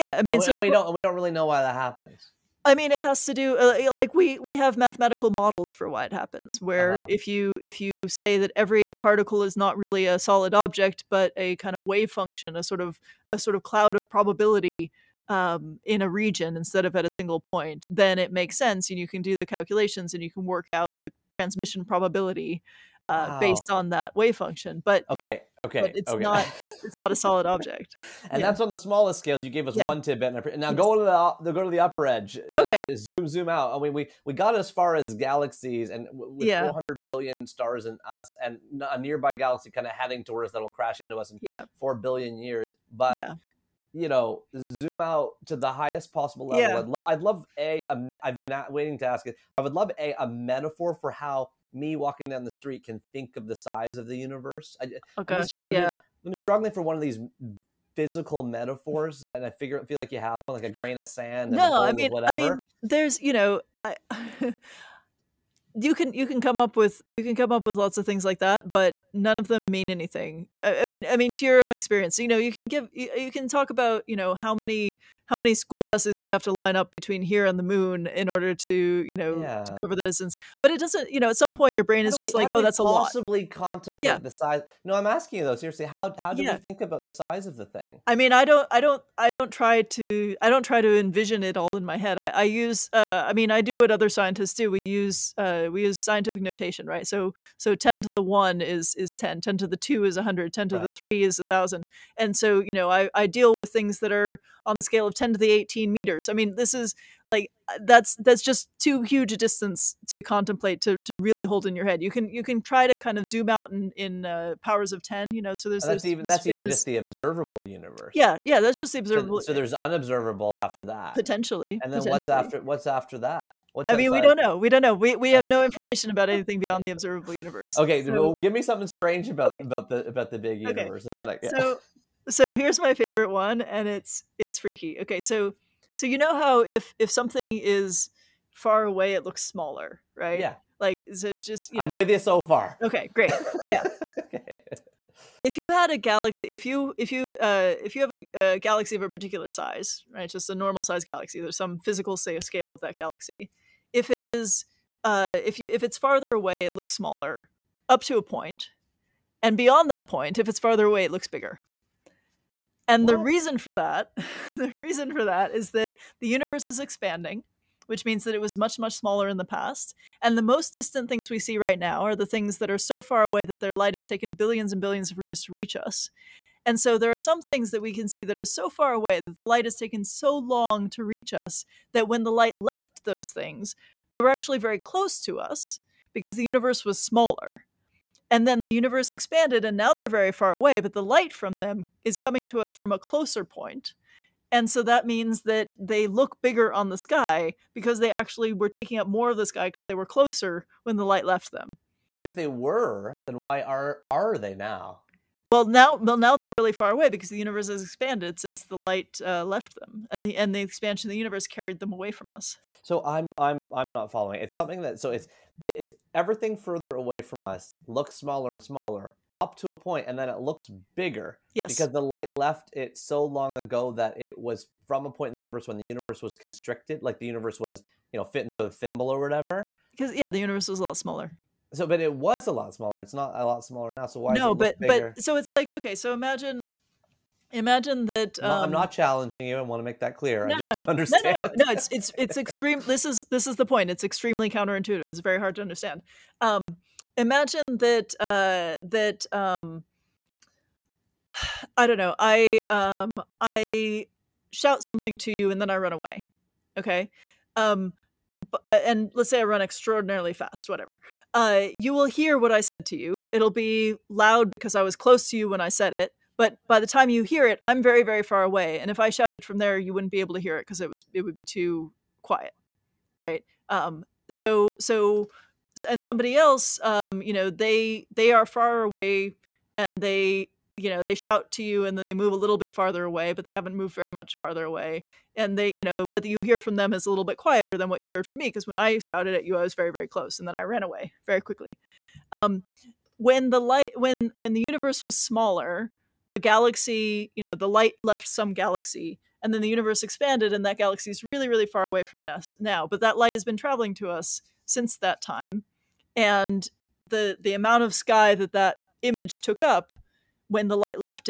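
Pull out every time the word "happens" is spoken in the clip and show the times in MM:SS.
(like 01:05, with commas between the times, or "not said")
00:01, 00:06.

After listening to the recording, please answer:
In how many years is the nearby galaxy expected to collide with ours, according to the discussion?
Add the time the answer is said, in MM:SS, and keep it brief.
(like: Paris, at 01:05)
4 billion years, at 00:41.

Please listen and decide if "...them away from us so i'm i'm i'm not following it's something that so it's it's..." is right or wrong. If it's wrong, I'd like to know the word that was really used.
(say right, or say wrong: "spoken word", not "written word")
right.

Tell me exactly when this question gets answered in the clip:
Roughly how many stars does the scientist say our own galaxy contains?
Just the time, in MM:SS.
00:36.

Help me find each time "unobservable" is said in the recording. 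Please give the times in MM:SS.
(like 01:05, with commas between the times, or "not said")
01:59.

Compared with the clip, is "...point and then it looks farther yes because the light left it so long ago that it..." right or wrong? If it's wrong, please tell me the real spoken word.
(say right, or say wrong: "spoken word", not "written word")
wrong: "bigger", not "farther".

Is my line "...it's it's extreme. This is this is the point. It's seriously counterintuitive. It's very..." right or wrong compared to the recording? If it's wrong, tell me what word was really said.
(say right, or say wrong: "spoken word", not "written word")
wrong: "extremely", not "seriously".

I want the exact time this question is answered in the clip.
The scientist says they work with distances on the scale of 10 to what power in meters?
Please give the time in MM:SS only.
01:45.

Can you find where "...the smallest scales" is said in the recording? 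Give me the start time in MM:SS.
00:28.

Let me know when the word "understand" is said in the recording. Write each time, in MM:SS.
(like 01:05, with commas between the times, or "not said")
04:00, 04:05.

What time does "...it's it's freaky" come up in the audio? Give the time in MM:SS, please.
02:13.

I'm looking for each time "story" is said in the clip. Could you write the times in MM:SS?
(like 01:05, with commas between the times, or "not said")
not said.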